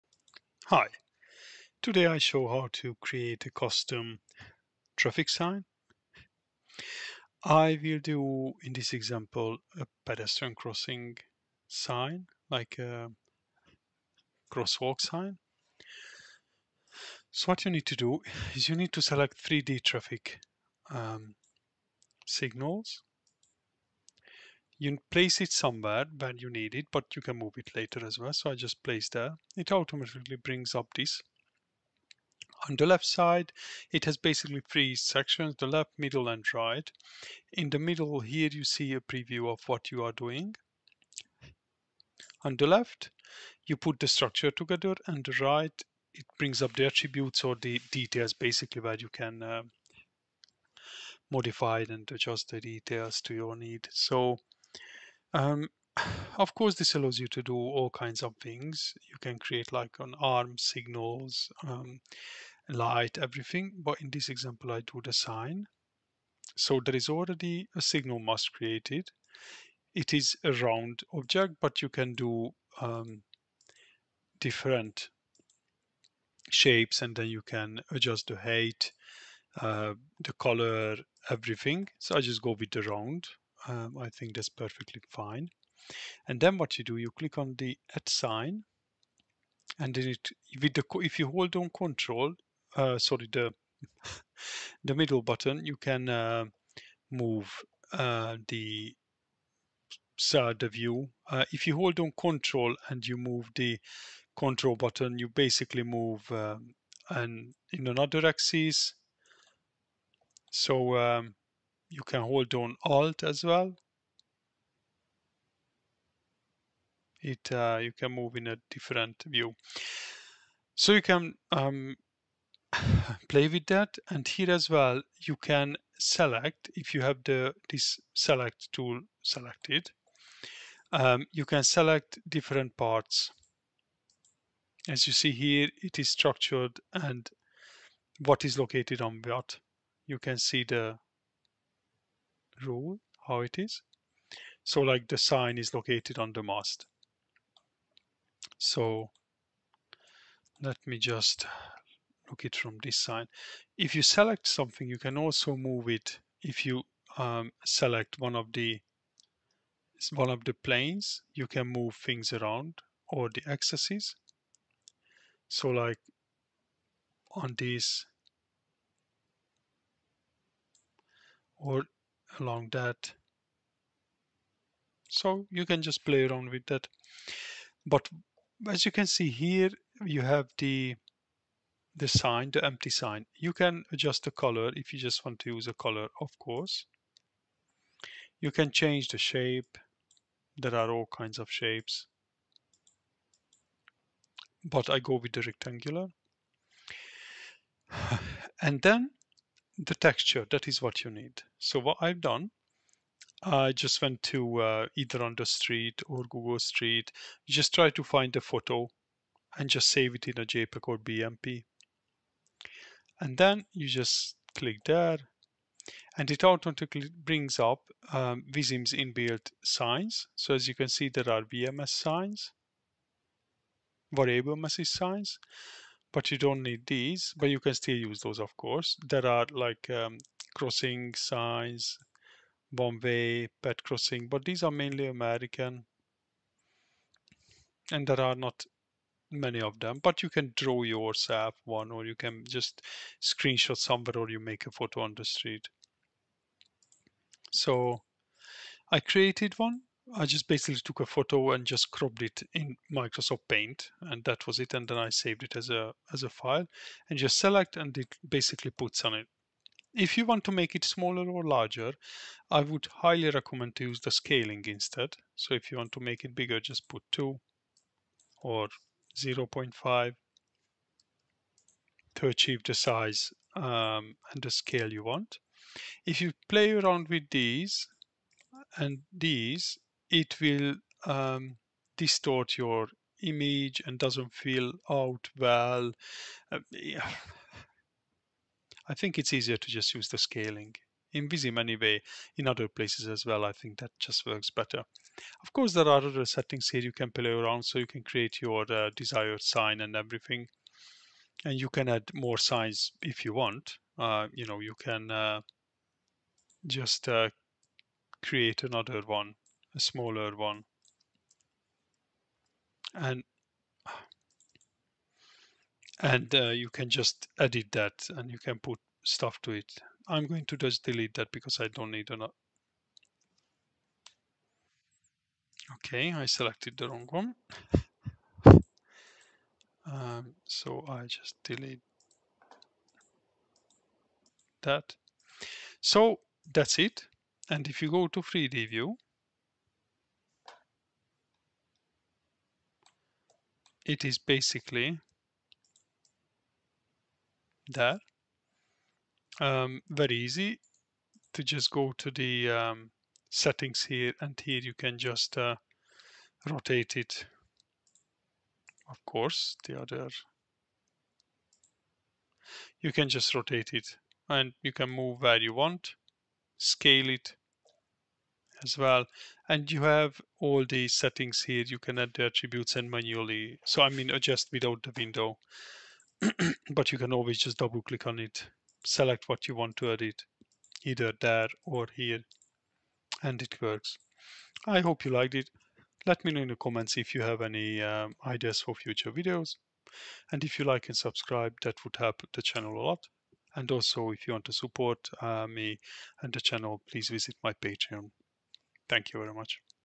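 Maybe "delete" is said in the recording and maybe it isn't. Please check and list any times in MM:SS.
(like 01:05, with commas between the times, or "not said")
05:20, 05:31.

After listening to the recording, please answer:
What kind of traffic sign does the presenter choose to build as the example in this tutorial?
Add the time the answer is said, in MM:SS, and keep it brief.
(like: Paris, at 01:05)
pedestrian crossing sign, at 00:10.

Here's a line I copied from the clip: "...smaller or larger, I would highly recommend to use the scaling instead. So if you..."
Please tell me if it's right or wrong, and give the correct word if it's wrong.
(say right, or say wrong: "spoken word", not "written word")
right.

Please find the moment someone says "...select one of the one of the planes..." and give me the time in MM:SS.
02:37.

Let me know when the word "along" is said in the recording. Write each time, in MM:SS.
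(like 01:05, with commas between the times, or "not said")
02:52.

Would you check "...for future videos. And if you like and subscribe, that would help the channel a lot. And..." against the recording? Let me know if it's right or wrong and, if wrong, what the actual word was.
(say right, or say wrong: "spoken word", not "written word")
right.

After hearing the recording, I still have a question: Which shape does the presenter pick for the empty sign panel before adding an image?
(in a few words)
rectangular.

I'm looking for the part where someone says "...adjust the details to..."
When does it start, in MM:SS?
00:52.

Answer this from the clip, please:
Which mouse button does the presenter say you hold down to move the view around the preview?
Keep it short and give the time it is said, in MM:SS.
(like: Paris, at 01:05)
middle button, at 01:34.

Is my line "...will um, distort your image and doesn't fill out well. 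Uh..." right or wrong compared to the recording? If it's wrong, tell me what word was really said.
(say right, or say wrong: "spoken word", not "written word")
right.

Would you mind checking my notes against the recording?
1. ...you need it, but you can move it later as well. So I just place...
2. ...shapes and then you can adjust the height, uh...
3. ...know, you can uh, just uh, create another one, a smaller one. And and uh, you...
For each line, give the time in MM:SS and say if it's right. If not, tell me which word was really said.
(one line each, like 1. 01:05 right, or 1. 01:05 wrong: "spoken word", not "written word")
1. 00:26 right
2. 01:16 right
3. 05:04 right.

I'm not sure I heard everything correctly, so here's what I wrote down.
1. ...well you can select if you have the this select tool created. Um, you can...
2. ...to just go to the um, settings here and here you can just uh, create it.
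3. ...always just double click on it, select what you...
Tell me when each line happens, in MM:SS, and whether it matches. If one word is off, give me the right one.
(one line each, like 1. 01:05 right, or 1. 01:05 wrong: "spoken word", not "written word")
1. 02:04 wrong: "selected", not "created"
2. 05:51 wrong: "rotate", not "create"
3. 06:17 right.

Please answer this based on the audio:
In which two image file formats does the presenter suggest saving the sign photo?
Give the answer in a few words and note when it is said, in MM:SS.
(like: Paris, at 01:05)
JPEG or BMP, at 03:30.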